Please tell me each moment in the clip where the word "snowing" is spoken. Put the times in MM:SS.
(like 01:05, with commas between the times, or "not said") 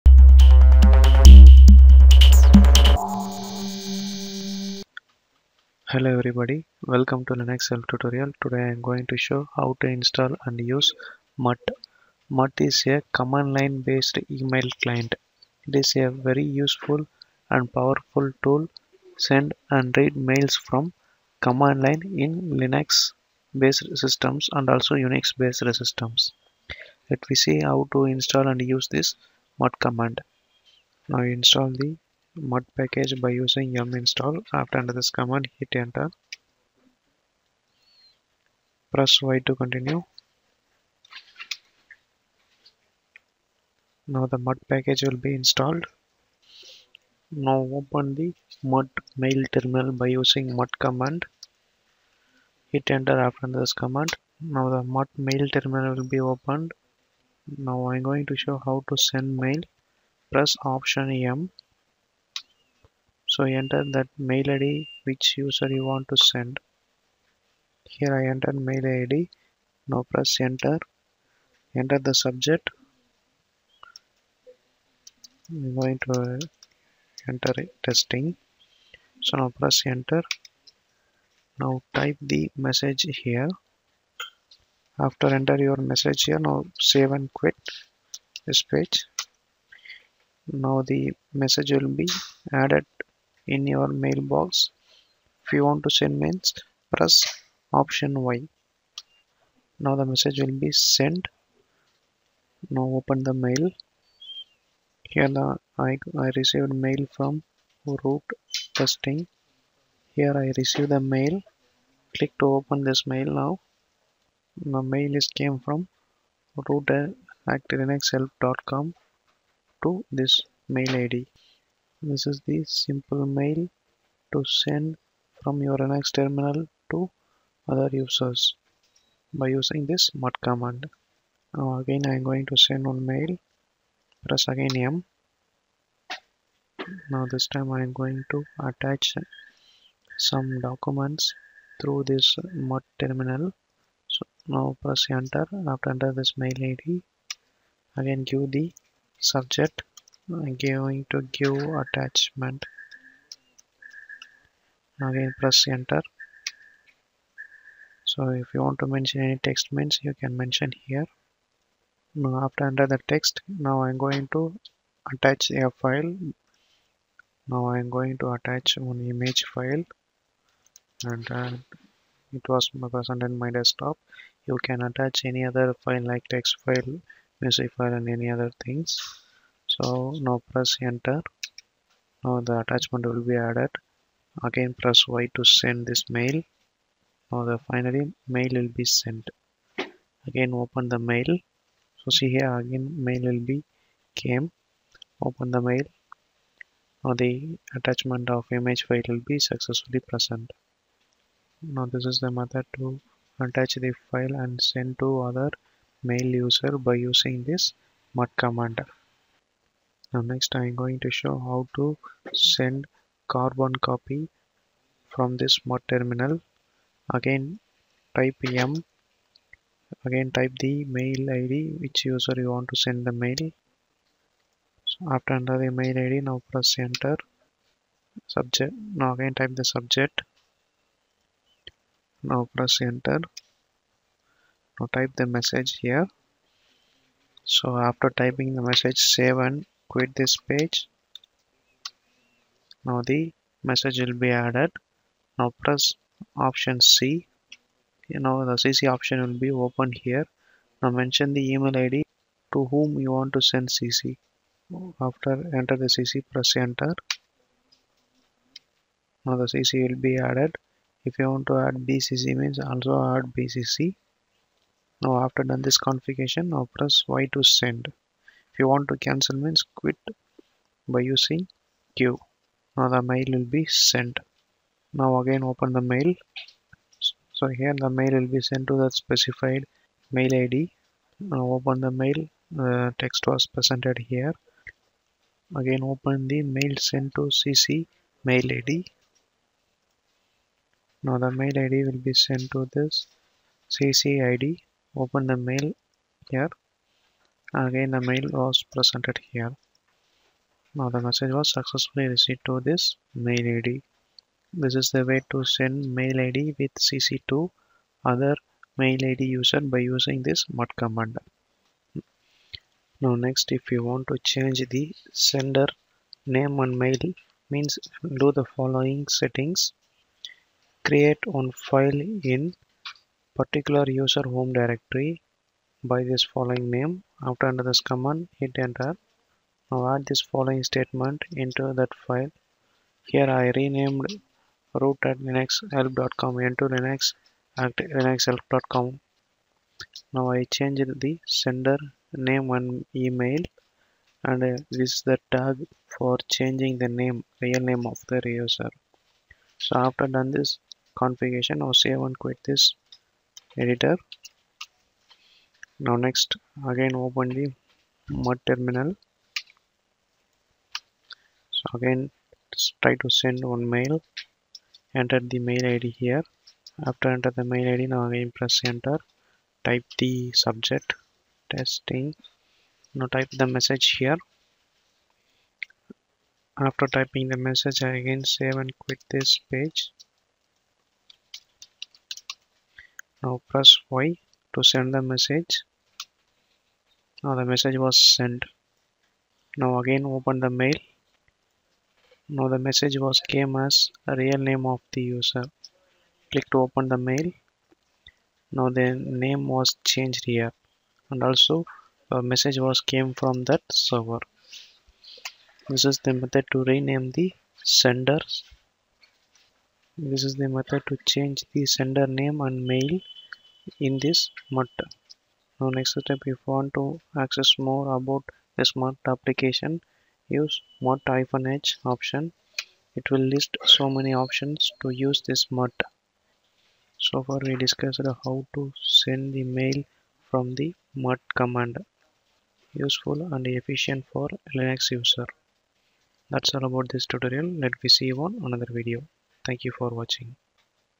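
not said.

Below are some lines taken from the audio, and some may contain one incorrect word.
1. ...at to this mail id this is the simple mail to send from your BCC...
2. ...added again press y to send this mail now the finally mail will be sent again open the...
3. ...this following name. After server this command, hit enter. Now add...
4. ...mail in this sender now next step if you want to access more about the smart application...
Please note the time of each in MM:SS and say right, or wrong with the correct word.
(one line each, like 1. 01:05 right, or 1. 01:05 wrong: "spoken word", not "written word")
1. 01:57 wrong: "Linux", not "BCC"
2. 03:03 right
3. 05:26 wrong: "under", not "server"
4. 06:52 wrong: "matter", not "sender".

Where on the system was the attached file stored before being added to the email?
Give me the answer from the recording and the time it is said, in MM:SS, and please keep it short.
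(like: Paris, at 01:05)
desktop, at 02:52.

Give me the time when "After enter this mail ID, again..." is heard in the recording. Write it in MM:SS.
02:25.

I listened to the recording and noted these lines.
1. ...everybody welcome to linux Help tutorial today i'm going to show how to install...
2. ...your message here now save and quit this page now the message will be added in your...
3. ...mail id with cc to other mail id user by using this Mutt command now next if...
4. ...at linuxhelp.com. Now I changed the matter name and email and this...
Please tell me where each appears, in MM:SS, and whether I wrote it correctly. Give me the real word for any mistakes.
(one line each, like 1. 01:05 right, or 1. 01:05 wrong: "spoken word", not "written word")
1. 00:06 right
2. 01:25 right
3. 05:05 right
4. 05:37 wrong: "sender", not "matter".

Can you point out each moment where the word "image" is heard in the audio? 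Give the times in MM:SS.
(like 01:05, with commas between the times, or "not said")
02:49, 03:18.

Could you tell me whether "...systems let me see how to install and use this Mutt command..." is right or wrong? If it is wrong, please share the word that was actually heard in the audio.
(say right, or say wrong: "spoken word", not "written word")
right.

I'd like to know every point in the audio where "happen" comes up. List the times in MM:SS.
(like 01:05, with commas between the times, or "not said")
not said.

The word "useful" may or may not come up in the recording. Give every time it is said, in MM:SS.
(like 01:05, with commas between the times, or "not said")
00:16, 07:12.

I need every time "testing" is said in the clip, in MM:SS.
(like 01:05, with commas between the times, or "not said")
01:17, 01:48, 06:11.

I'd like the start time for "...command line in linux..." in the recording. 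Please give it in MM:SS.
00:21.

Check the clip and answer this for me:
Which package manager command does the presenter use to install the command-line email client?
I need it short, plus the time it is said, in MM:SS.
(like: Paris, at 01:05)
yum install, at 00:33.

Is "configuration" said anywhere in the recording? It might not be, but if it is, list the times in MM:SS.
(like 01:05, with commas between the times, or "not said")
04:25, 05:50.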